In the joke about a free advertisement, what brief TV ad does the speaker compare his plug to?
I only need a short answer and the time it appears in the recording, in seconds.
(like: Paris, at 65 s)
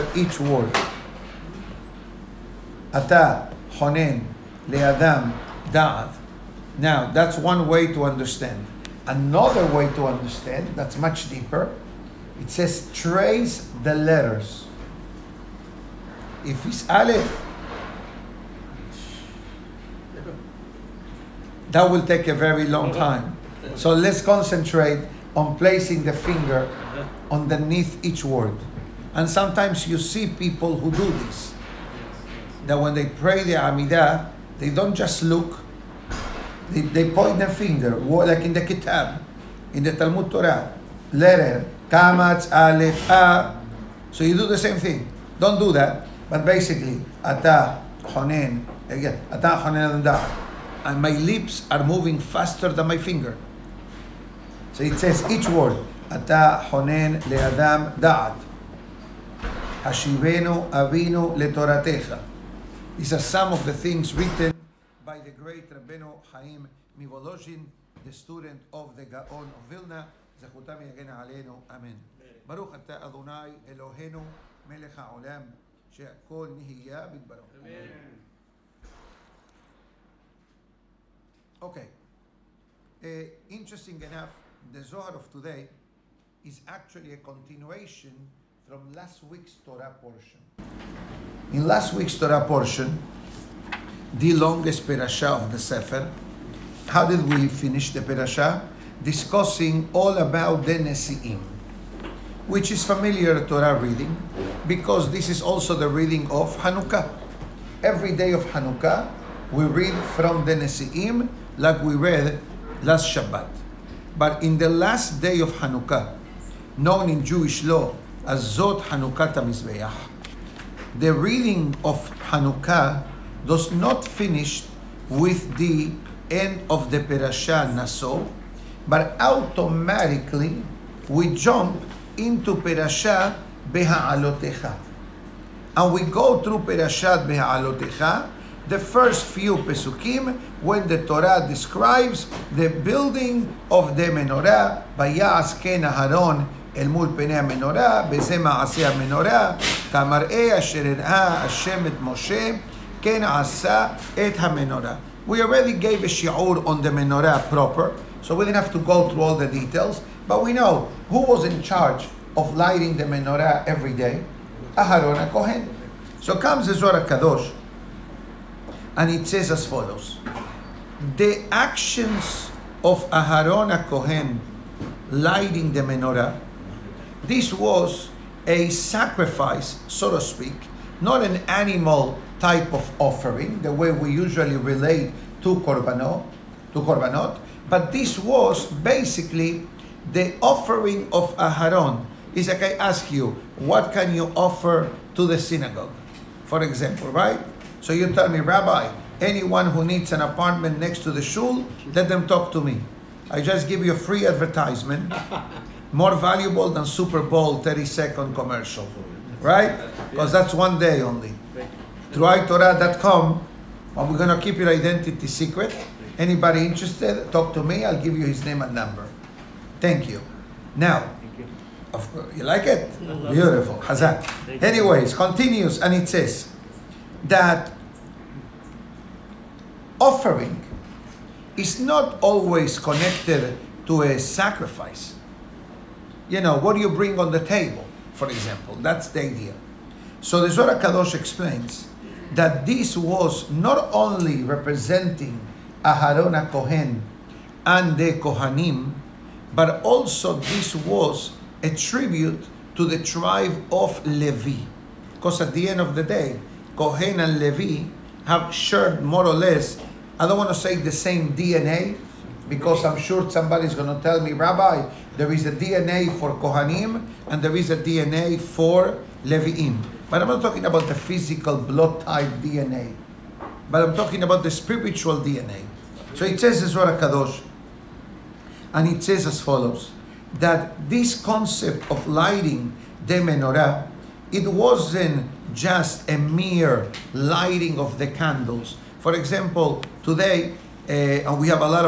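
Super Bowl 30 second commercial, at 206 s.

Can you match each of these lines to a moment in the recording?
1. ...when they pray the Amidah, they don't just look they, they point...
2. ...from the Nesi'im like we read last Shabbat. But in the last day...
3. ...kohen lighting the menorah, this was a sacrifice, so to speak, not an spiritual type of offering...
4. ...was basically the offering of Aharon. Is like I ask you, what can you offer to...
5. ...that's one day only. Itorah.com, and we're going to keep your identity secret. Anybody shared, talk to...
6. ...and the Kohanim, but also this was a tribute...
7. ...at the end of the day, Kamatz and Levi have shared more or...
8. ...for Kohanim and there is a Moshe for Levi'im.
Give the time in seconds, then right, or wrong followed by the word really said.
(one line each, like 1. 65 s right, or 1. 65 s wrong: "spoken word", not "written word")
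1. 32 s right
2. 110 s right
3. 173 s wrong: "animal", not "spiritual"
4. 188 s right
5. 210 s wrong: "interested", not "shared"
6. 247 s right
7. 255 s wrong: "Kohen", not "Kamatz"
8. 266 s wrong: "DNA", not "Moshe".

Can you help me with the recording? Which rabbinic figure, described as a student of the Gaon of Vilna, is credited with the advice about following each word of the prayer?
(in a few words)
Rabbeinu Chaim Mivolozhin.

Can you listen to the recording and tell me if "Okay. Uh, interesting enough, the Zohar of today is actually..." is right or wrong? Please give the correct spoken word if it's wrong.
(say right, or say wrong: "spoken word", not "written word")
right.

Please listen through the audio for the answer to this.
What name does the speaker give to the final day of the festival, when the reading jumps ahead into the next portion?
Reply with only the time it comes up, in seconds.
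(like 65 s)
118 s.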